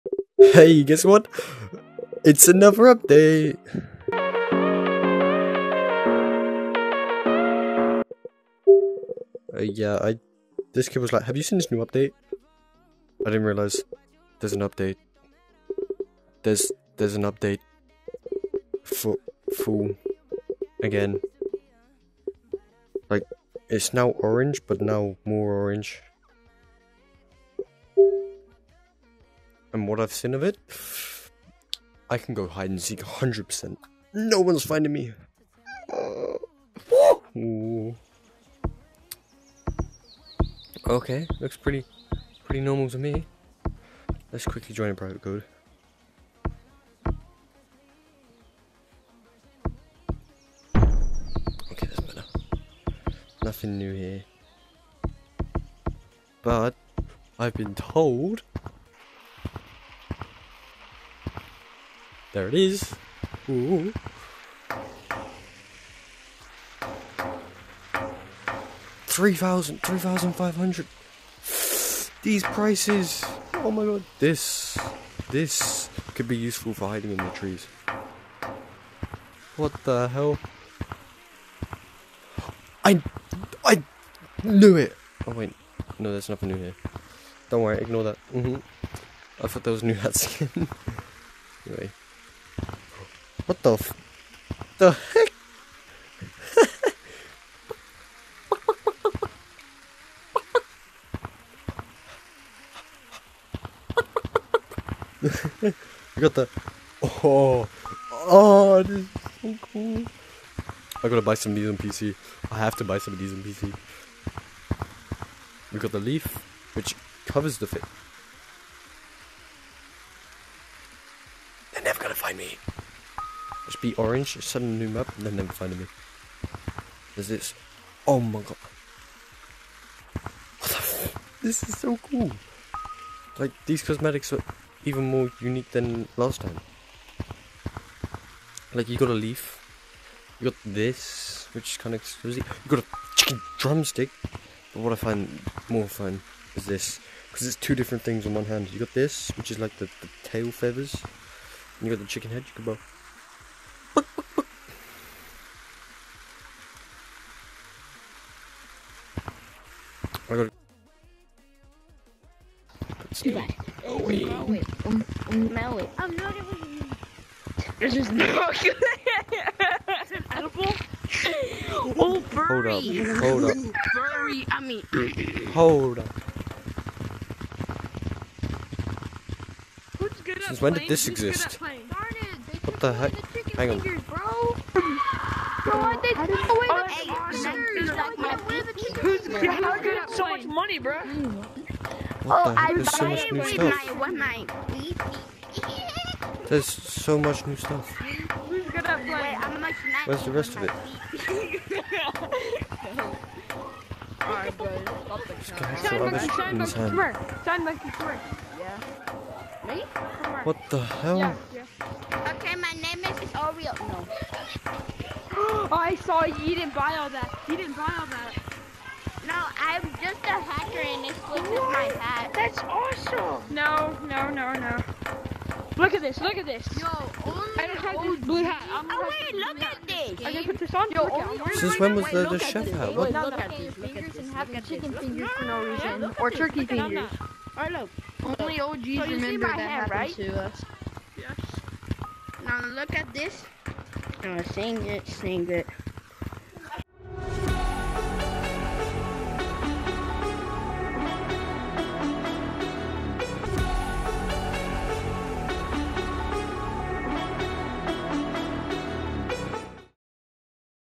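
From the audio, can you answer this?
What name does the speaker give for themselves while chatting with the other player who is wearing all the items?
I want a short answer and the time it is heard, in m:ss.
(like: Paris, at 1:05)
Oreo, at 3:33.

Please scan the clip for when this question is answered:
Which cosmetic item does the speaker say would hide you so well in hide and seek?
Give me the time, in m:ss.
1:55.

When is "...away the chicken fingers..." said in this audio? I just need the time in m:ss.
3:06.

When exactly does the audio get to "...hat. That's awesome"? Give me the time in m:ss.
3:42.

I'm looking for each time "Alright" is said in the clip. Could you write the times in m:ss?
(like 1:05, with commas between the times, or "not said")
3:24, 3:57.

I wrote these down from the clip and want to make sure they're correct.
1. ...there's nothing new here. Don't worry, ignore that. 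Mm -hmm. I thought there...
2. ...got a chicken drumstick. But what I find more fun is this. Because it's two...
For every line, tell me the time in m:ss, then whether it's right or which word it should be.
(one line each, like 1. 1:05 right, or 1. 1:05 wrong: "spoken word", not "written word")
1. 1:26 right
2. 2:22 right.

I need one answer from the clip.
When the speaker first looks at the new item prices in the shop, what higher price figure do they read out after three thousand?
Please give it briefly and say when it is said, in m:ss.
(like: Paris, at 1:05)
3500, at 1:09.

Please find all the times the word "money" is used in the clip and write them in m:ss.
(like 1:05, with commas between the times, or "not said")
3:10.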